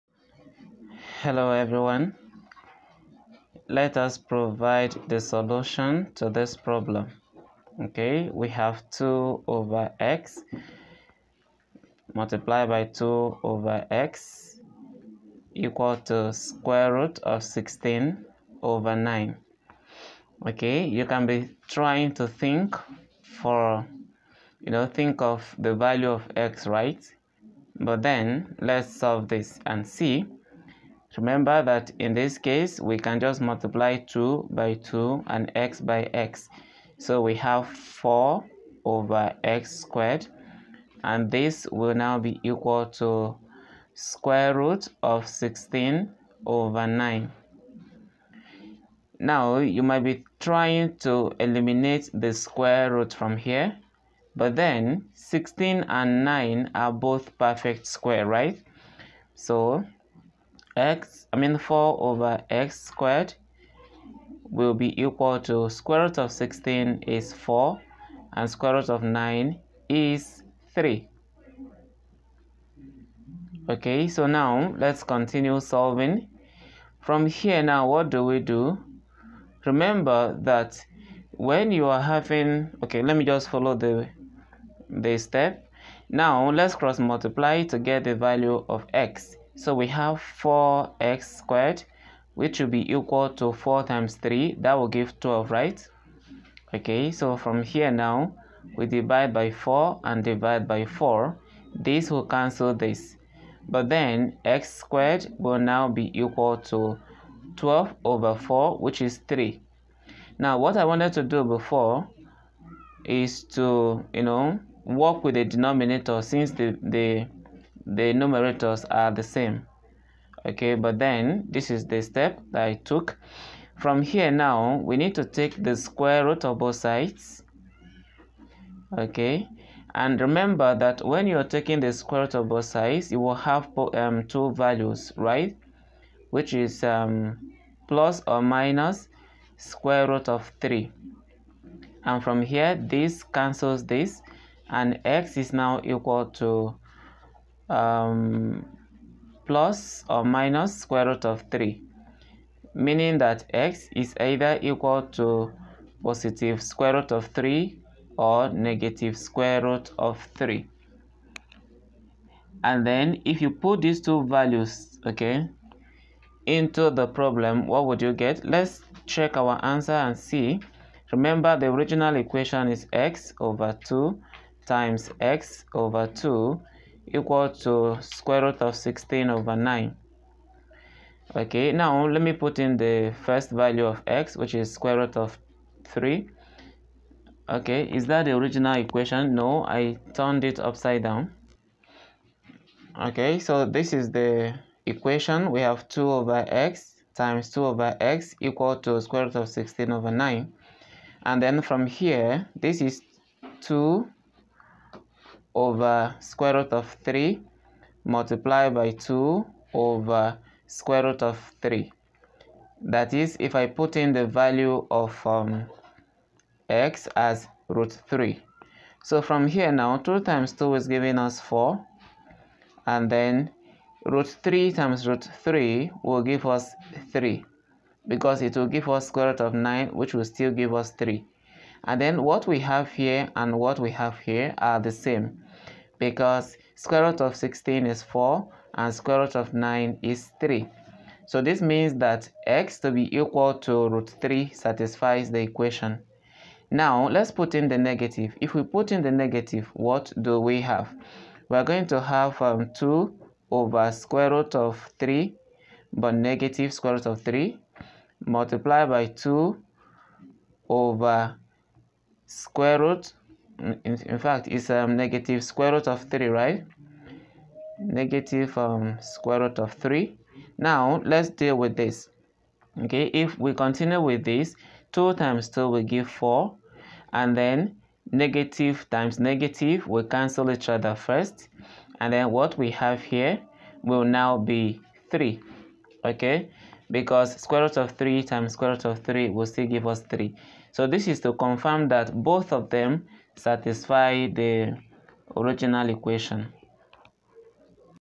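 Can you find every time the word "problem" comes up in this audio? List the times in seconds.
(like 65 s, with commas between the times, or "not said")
6 s, 167 s.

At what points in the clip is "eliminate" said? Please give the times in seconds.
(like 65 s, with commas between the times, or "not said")
51 s.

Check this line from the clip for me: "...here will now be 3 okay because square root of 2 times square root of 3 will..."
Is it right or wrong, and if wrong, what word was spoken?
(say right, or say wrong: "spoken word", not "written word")
wrong: "3", not "2".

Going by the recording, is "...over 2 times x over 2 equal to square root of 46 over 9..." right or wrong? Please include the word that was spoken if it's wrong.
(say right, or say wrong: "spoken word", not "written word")
wrong: "16", not "46".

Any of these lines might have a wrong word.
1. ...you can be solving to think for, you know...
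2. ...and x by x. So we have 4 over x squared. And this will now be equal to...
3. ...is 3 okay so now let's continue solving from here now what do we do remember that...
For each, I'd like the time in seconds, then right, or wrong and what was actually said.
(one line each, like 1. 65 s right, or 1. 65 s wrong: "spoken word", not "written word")
1. 20 s wrong: "trying", not "solving"
2. 35 s right
3. 69 s right.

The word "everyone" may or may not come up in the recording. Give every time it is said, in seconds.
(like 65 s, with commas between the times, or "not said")
1 s.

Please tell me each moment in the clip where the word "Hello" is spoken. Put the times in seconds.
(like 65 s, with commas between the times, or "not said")
1 s.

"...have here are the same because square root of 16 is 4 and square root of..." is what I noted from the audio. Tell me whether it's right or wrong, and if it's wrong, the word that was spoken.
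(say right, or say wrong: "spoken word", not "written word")
right.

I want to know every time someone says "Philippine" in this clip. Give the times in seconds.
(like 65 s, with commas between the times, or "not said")
not said.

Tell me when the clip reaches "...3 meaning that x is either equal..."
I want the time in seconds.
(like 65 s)
151 s.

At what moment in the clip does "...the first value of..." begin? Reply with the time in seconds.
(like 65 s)
182 s.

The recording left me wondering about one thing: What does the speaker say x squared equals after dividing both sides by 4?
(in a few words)
3.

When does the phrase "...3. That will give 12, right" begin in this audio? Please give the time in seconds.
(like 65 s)
94 s.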